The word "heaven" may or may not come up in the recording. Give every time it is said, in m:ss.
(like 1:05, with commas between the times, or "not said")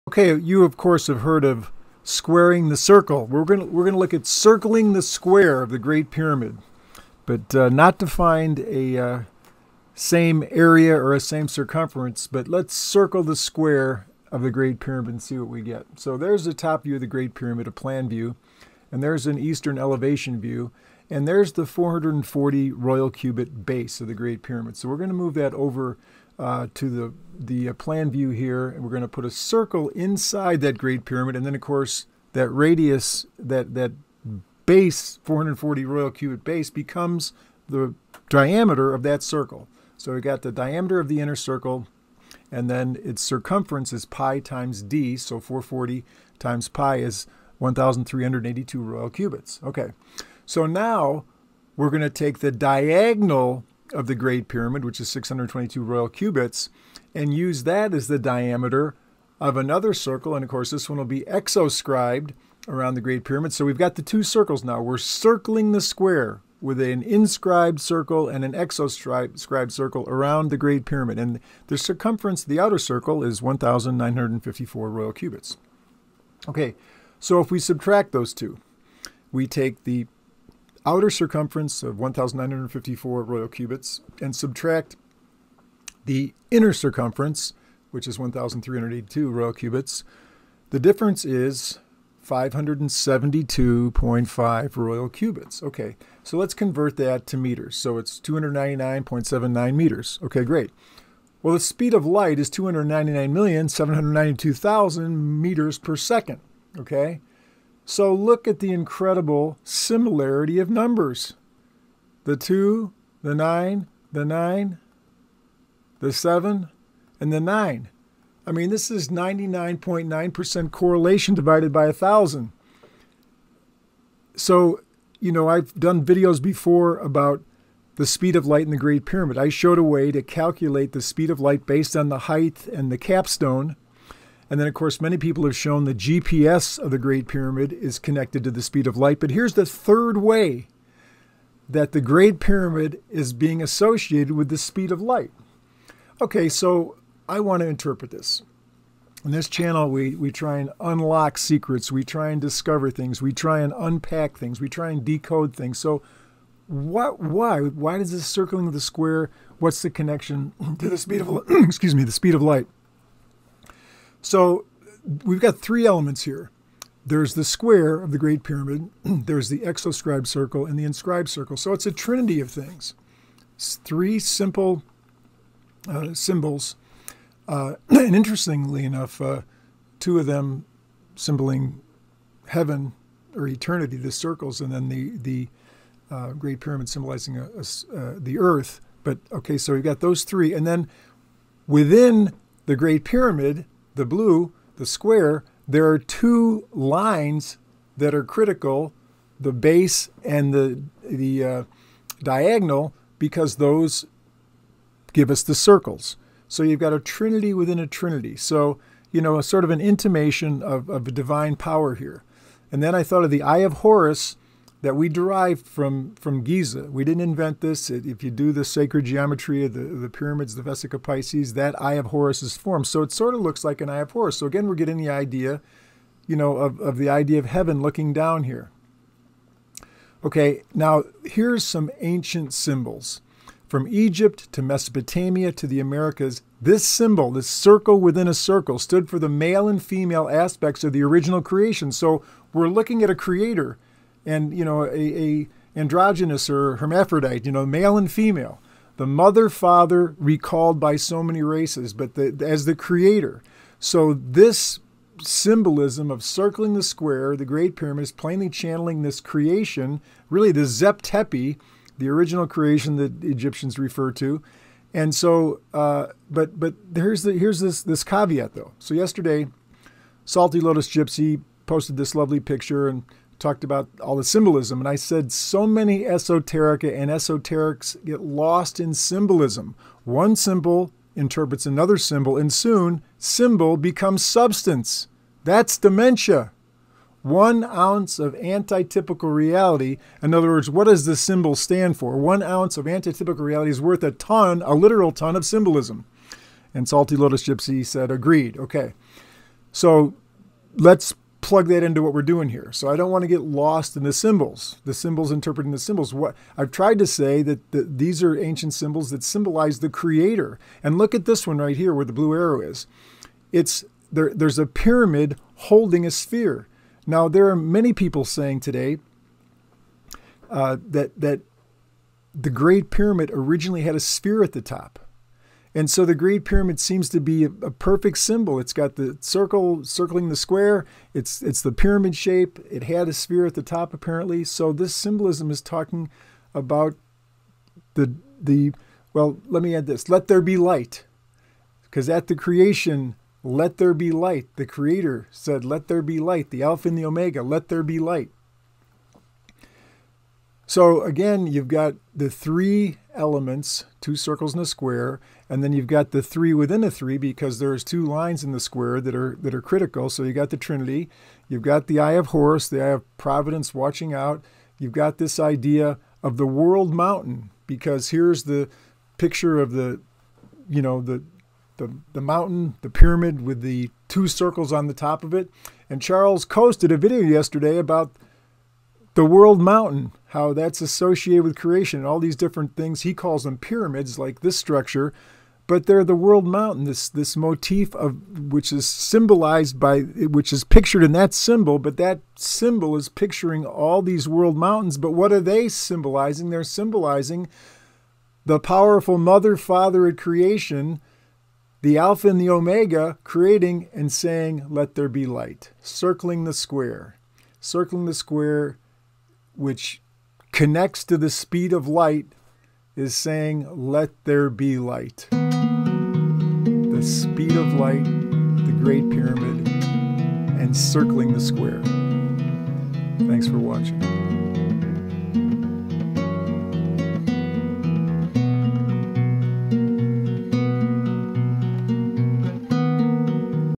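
3:02, 3:47.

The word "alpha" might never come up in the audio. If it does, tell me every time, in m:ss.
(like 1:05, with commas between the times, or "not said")
5:46, 6:41.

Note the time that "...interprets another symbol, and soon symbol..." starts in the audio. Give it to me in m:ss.
4:41.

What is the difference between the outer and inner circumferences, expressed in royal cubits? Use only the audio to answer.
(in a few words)
572.5.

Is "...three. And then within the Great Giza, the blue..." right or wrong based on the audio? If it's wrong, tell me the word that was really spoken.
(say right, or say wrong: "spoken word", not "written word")
wrong: "Pyramid", not "Giza".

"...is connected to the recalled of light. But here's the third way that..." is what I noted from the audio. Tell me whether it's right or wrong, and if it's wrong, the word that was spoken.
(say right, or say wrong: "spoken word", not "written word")
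wrong: "speed", not "recalled".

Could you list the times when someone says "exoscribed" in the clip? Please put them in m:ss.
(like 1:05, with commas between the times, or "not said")
1:01, 1:08, 2:49.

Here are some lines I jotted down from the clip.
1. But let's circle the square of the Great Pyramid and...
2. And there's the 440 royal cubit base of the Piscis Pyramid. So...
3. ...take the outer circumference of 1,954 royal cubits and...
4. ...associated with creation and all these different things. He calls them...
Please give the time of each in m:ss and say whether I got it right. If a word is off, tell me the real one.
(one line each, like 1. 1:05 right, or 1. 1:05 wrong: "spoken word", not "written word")
1. 0:12 right
2. 0:21 wrong: "Great", not "Piscis"
3. 1:19 right
4. 6:20 right.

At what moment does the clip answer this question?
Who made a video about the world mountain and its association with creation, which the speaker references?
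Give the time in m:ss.
6:16.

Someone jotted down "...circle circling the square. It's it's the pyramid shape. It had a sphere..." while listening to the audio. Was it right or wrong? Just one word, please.
right.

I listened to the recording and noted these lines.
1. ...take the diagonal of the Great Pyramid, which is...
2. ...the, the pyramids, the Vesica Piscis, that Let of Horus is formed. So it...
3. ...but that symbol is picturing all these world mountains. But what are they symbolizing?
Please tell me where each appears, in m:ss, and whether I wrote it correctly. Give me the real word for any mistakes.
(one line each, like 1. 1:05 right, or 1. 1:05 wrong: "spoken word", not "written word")
1. 0:52 right
2. 3:39 wrong: "Eye", not "Let"
3. 6:31 right.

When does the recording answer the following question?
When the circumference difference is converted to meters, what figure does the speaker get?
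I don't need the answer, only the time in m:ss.
1:38.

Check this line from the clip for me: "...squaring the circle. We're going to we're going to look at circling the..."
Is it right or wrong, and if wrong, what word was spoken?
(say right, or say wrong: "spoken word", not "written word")
right.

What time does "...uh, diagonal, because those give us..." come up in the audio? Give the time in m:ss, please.
3:21.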